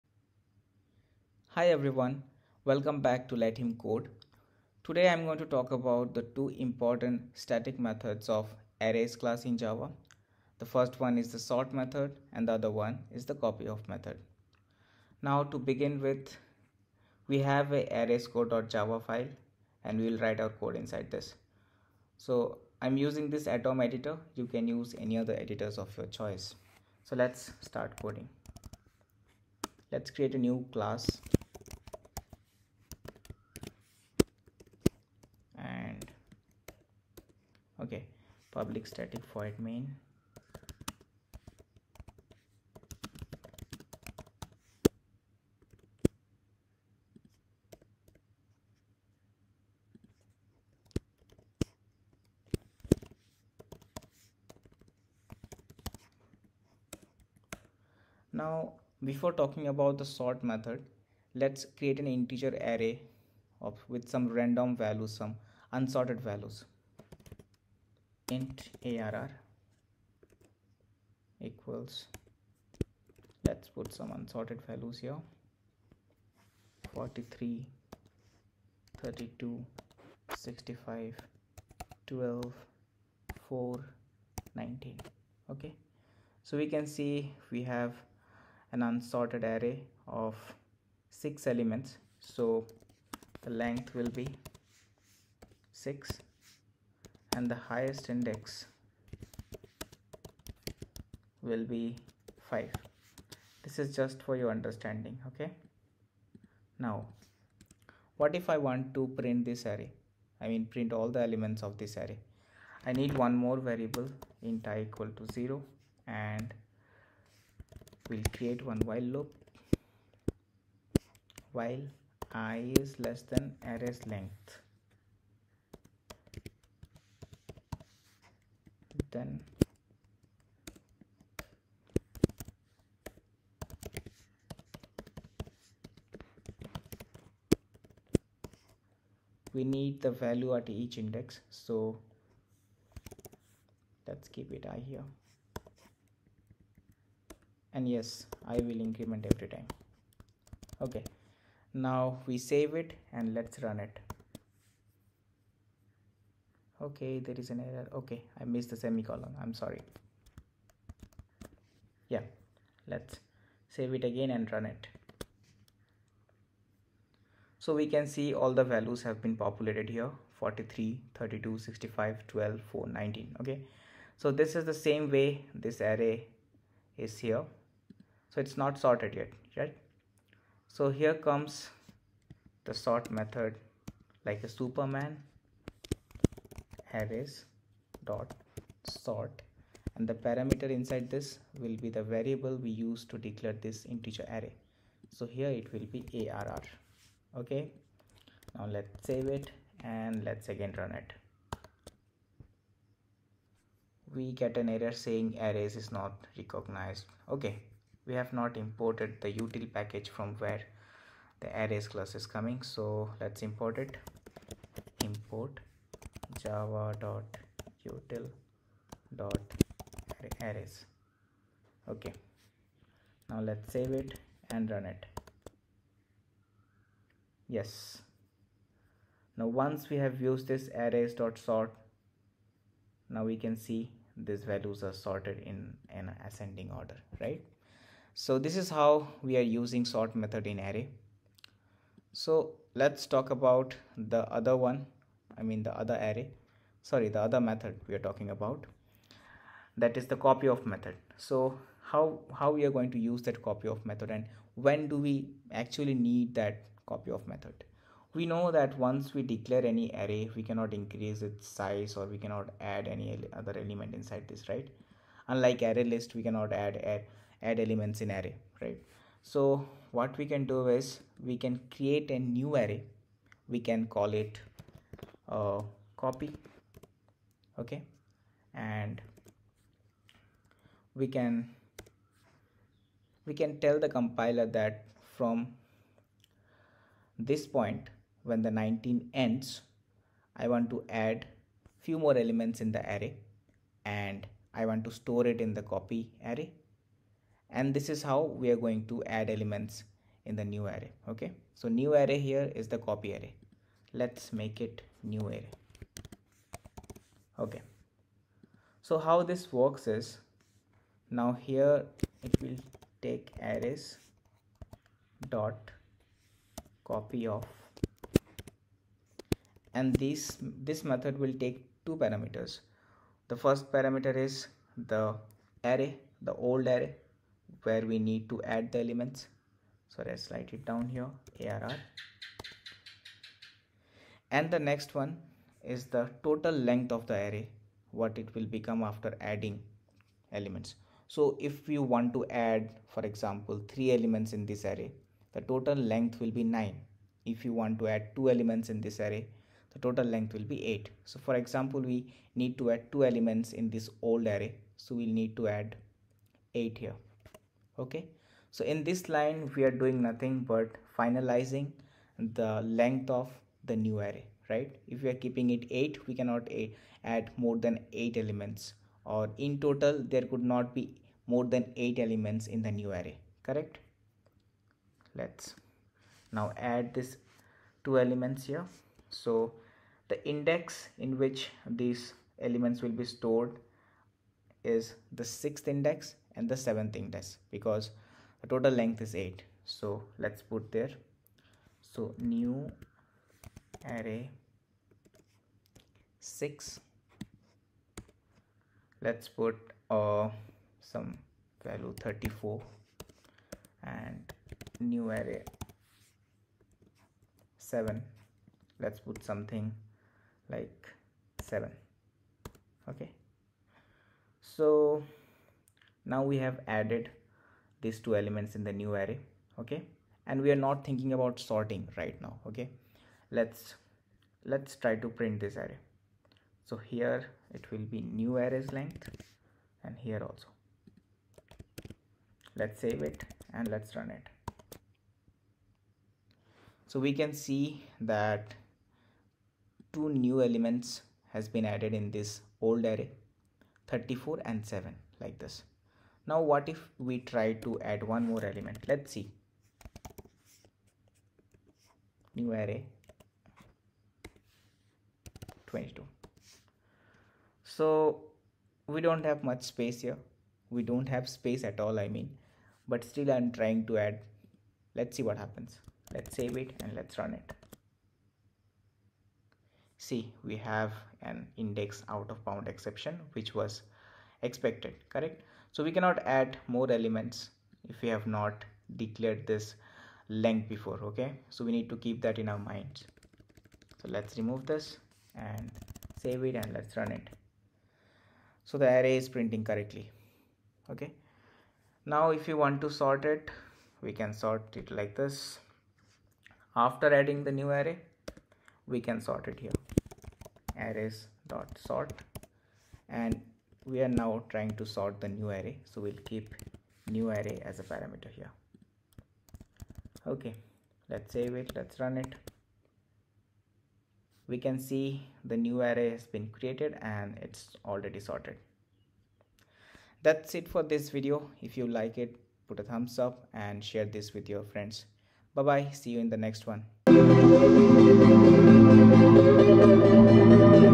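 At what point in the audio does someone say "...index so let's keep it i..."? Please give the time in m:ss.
2:20.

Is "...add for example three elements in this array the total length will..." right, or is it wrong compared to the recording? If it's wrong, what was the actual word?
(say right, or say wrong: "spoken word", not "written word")
right.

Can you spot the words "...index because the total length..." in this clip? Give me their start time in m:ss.
6:26.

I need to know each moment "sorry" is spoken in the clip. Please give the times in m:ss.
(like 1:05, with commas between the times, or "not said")
2:39, 4:06.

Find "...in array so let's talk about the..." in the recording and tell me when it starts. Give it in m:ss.
4:00.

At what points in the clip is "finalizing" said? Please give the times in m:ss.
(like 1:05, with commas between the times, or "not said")
6:00.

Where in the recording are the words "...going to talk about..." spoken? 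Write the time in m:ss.
0:05.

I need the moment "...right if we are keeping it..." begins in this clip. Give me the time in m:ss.
6:04.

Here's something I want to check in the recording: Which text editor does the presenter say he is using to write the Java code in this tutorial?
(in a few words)
Atom.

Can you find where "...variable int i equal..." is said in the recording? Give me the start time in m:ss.
1:53.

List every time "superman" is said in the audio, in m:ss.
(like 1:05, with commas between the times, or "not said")
3:04.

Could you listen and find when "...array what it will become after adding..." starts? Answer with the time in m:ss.
5:37.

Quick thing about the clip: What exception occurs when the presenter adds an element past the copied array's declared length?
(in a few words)
index out of bound exception.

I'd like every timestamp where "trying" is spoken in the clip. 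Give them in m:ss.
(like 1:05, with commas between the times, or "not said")
7:43, 8:24.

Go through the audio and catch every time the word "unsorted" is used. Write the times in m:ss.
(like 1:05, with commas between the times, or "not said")
1:05, 1:14, 1:28.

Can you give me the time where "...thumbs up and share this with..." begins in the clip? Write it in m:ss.
8:42.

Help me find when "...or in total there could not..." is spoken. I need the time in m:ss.
6:09.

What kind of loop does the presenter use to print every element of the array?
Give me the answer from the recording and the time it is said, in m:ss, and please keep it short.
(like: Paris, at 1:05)
while loop, at 1:58.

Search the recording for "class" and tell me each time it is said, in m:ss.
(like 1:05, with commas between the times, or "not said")
0:09, 0:30, 3:31.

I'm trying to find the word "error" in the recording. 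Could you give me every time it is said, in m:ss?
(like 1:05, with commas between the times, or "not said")
2:37, 3:24.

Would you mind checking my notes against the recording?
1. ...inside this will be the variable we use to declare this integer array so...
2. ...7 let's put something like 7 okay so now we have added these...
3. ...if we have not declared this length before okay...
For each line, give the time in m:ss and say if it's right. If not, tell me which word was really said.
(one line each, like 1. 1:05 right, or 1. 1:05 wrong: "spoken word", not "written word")
1. 3:10 right
2. 6:47 right
3. 7:57 right.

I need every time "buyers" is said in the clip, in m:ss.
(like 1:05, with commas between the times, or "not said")
not said.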